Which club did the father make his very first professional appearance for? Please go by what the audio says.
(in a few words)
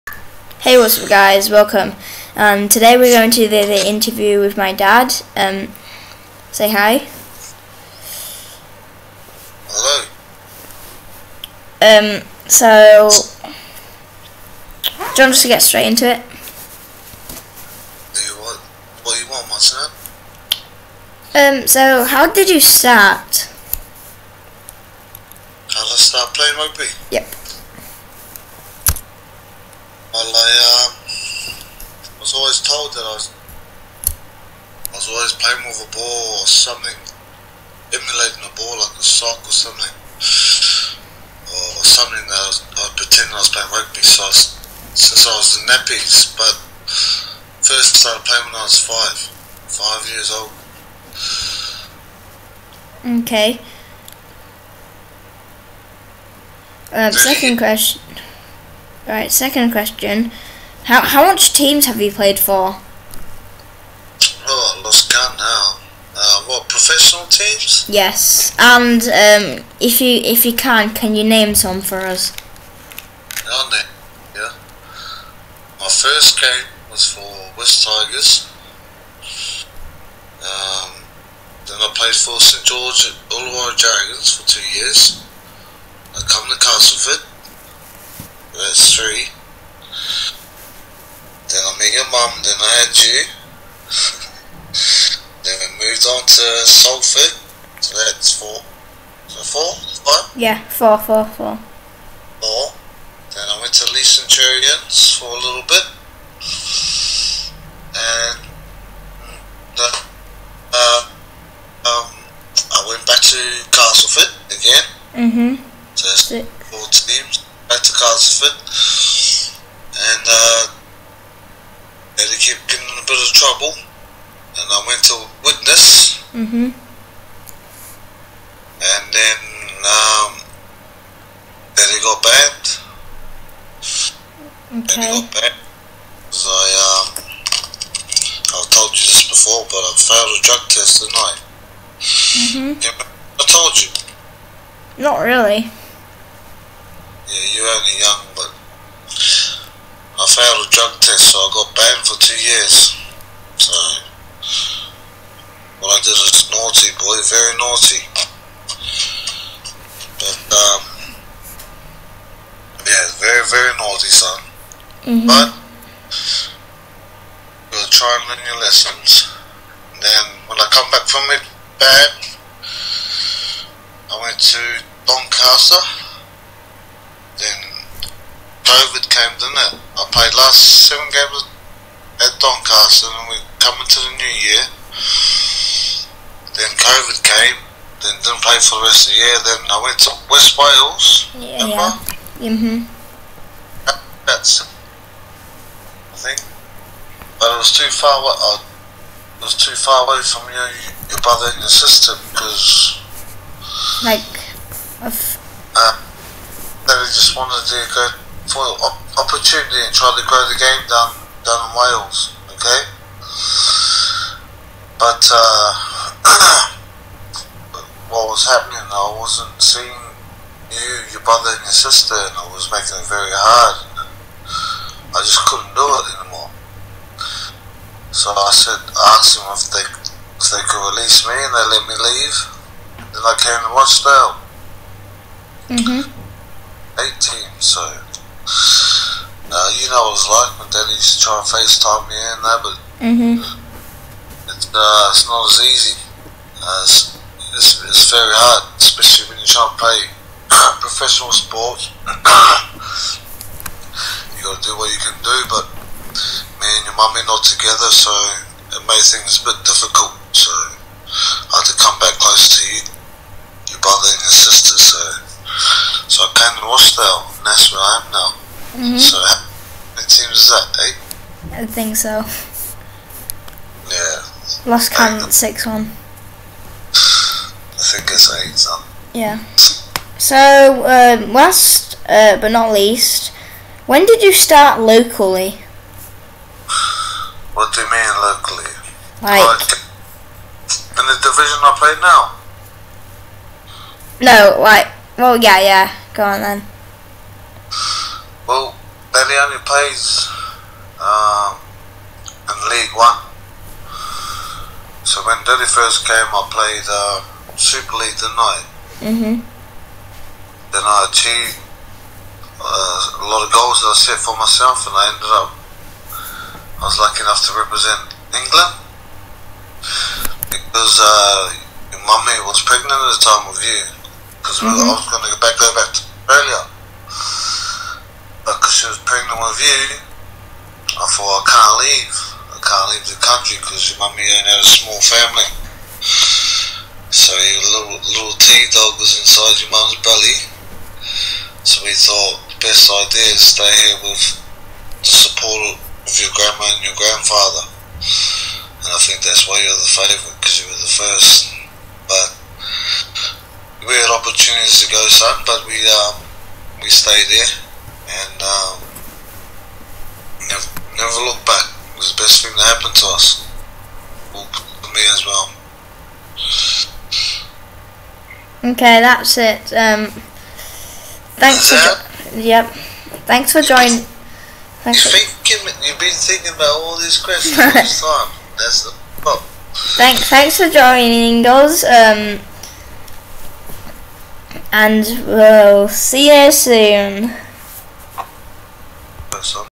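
Wests Tigers.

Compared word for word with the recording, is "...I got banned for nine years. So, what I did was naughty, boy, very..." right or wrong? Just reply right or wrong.
wrong.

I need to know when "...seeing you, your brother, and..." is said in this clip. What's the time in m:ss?
3:39.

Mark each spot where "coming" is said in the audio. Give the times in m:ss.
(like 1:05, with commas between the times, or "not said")
3:03.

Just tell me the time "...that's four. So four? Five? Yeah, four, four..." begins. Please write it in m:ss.
1:37.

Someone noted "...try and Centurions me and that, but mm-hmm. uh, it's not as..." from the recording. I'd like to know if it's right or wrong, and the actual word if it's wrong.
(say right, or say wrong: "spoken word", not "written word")
wrong: "FaceTime", not "Centurions".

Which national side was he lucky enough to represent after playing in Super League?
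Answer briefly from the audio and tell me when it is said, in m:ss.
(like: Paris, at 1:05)
England, at 5:18.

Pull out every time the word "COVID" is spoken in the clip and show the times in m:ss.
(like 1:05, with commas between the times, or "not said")
2:58, 3:06.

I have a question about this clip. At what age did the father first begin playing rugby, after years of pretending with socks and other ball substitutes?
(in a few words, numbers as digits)
5.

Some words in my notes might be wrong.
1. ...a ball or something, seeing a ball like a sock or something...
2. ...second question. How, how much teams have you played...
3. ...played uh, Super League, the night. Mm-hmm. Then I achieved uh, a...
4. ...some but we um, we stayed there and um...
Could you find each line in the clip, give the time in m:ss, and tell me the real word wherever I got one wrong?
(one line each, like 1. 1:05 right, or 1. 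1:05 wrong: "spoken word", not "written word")
1. 0:35 wrong: "emulating", not "seeing"
2. 0:59 right
3. 5:06 right
4. 5:55 right.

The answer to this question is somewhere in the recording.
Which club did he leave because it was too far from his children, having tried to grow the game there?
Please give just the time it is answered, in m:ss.
3:10.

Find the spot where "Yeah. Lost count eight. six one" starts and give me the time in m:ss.
4:33.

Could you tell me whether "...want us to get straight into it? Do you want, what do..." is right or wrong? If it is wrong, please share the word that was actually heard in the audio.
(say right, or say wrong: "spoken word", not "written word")
right.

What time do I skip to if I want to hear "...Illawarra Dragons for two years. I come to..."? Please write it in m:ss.
1:23.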